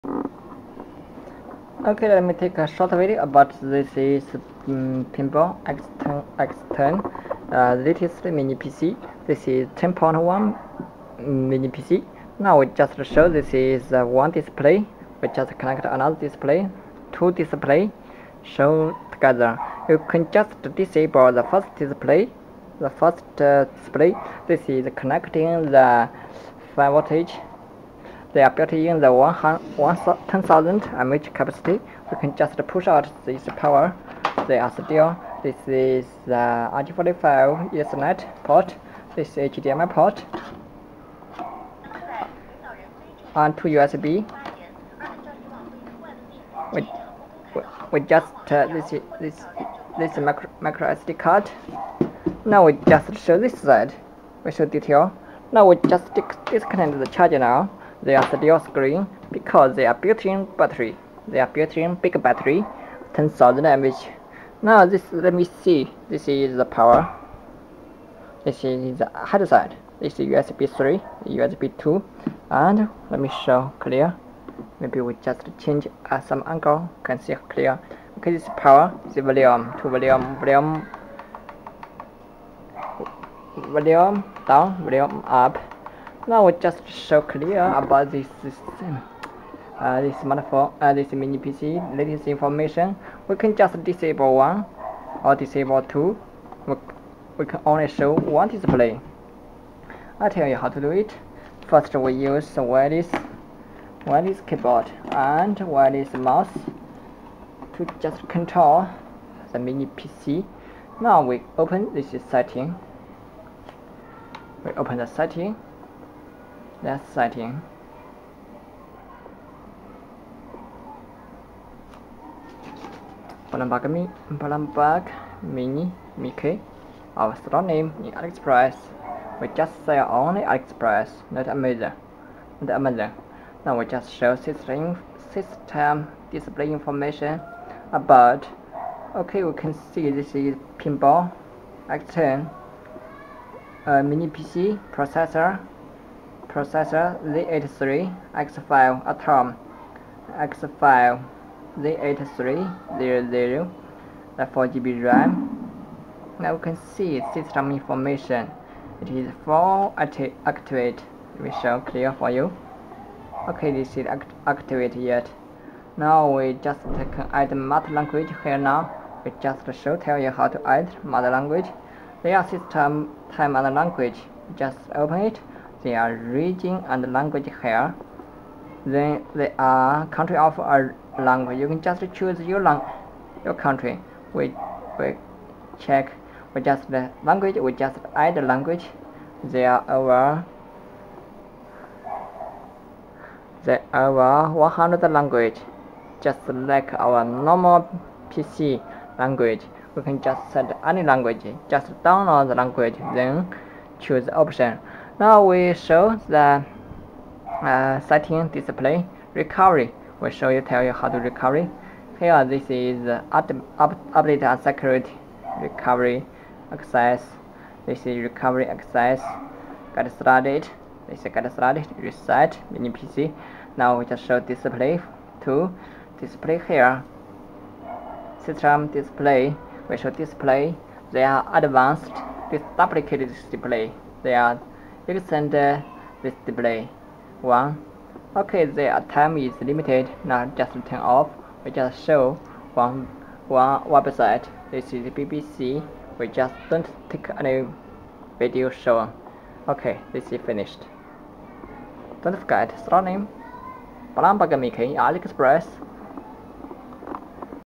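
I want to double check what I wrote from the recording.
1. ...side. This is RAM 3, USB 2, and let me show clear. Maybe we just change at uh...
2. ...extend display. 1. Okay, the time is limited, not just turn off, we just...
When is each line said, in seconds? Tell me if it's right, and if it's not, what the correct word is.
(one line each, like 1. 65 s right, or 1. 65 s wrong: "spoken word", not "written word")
1. 69 s wrong: "USB", not "RAM"
2. 235 s right.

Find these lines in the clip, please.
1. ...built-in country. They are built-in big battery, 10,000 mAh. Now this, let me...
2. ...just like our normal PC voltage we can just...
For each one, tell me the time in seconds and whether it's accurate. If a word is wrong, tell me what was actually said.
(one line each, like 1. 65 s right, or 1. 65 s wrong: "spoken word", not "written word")
1. 59 s wrong: "battery", not "country"
2. 196 s wrong: "language", not "voltage".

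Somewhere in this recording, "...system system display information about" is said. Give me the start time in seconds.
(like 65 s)
134 s.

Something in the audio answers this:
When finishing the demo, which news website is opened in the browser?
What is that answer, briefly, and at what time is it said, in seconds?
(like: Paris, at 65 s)
BBC, at 245 s.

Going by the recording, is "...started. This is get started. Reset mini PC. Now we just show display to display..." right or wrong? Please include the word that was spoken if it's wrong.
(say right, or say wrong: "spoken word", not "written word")
right.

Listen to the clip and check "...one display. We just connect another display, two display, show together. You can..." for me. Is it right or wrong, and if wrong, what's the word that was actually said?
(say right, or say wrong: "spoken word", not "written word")
right.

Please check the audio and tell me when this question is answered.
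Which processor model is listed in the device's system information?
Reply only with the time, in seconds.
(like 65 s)
149 s.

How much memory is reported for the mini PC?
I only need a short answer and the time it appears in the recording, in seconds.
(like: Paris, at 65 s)
4GB, at 154 s.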